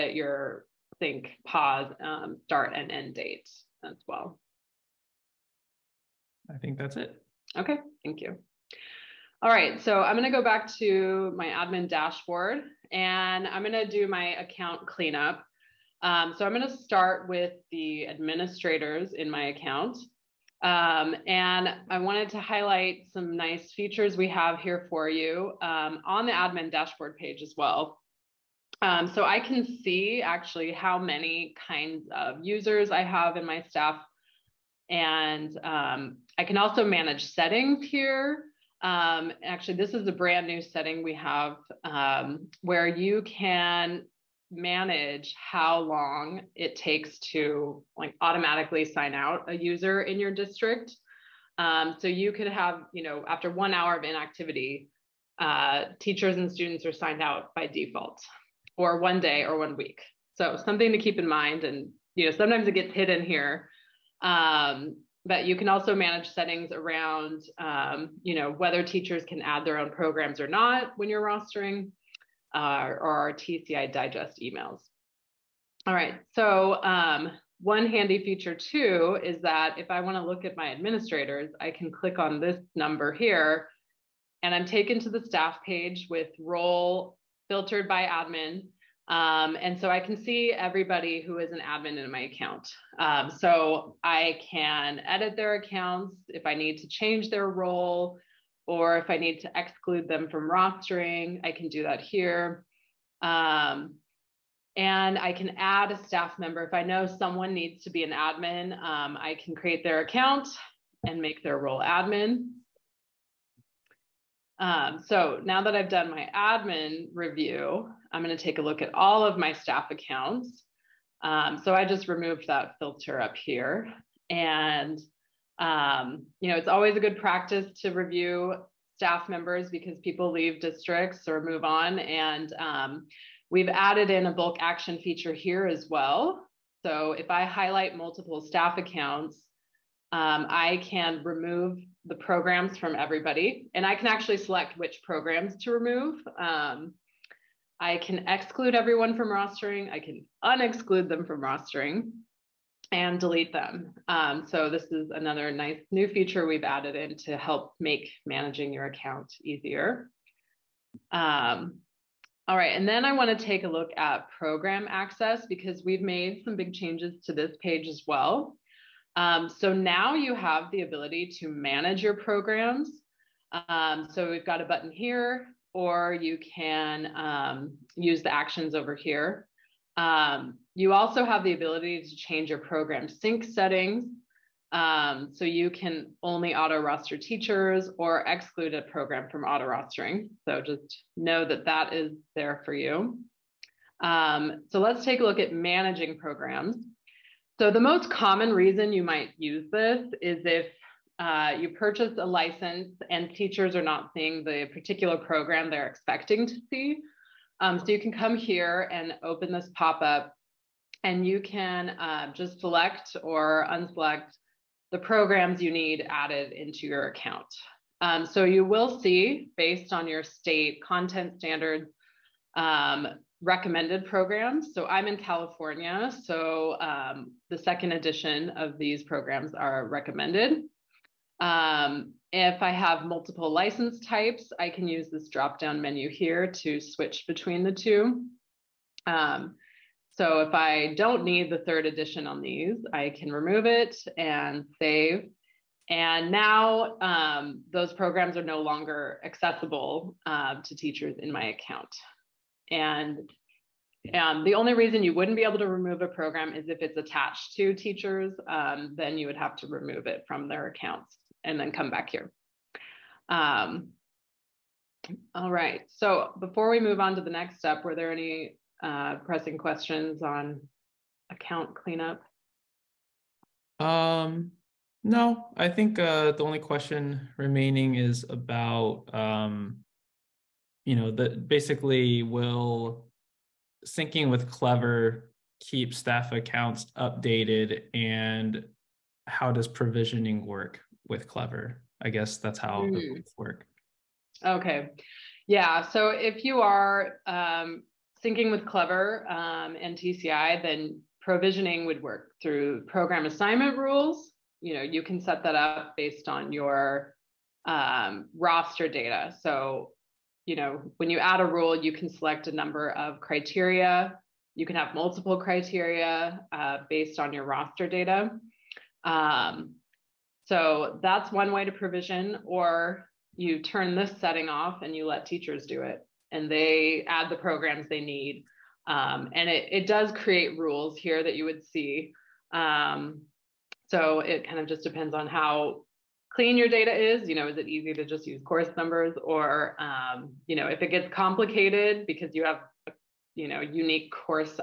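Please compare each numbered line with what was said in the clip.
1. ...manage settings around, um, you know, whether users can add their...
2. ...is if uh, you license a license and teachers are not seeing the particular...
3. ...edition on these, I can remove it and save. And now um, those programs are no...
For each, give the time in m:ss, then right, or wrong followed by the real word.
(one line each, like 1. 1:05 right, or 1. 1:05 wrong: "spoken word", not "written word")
1. 1:05 wrong: "teachers", not "users"
2. 3:20 wrong: "purchase", not "license"
3. 4:01 right.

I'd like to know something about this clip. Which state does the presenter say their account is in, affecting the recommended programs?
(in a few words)
California.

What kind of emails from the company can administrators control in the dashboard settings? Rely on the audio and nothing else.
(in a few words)
TCI digest emails.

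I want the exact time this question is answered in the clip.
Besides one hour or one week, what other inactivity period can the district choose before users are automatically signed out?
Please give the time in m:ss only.
0:58.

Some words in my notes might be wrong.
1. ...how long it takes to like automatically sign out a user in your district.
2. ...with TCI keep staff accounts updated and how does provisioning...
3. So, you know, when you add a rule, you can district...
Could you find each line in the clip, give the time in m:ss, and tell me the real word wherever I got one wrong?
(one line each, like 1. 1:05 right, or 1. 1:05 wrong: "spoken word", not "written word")
1. 0:45 right
2. 4:44 wrong: "Clever", not "TCI"
3. 5:09 wrong: "select", not "district".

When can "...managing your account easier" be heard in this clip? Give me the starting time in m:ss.
2:38.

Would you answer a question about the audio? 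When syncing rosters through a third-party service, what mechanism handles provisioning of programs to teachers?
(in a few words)
program assignment rules.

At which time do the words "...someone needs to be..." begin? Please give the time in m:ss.
1:47.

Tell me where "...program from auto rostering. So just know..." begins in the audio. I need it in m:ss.
3:08.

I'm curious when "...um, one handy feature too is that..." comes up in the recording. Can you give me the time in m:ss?
1:16.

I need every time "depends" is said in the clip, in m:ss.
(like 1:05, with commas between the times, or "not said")
5:34.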